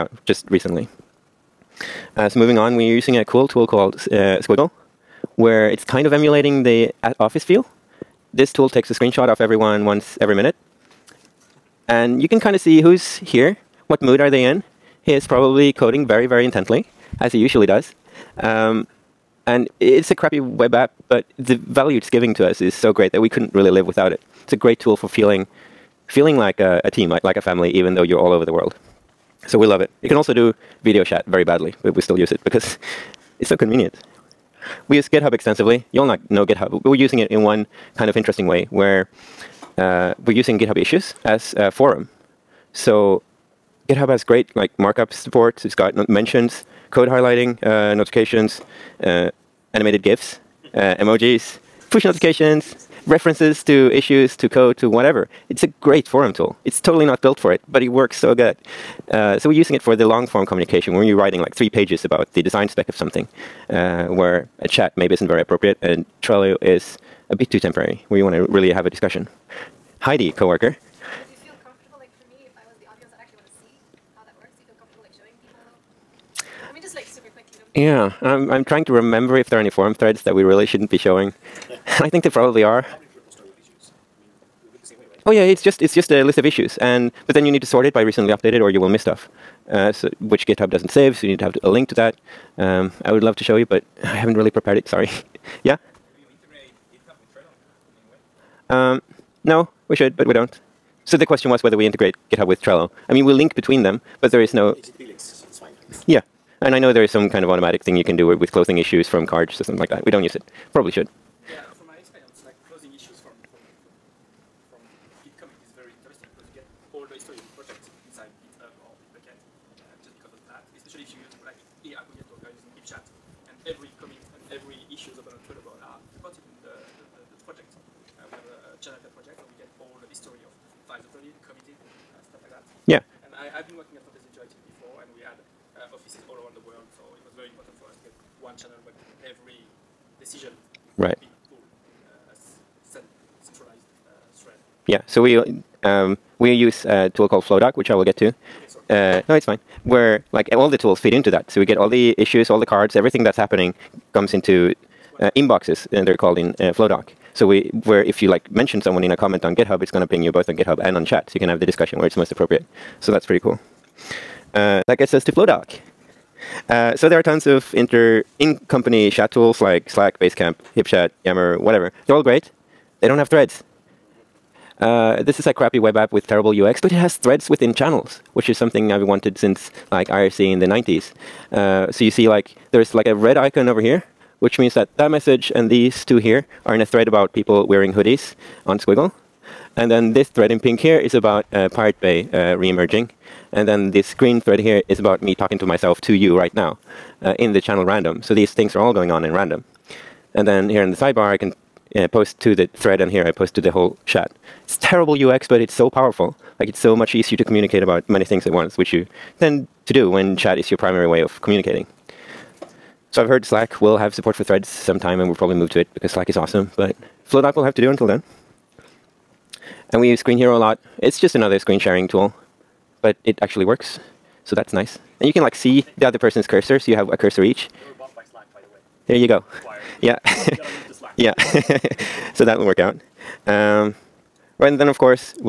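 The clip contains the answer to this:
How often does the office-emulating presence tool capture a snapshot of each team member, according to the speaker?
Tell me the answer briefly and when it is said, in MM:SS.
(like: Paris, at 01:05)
once every minute, at 00:09.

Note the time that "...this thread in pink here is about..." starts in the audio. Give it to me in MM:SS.
03:10.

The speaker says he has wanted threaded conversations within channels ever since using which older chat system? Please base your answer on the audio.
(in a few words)
IRC.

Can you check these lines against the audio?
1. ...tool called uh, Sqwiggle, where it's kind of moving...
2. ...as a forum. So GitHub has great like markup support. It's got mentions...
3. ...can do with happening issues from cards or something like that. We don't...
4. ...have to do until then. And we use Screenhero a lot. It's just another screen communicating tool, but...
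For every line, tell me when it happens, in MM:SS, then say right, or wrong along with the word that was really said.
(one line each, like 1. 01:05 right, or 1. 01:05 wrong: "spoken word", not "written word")
1. 00:03 wrong: "emulating", not "moving"
2. 00:41 right
3. 01:48 wrong: "closing", not "happening"
4. 03:37 wrong: "sharing", not "communicating".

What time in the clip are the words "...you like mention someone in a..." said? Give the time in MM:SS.
02:38.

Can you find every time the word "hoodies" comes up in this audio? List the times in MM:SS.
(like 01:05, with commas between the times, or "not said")
03:07.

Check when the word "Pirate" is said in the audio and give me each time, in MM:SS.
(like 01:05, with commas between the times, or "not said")
03:11.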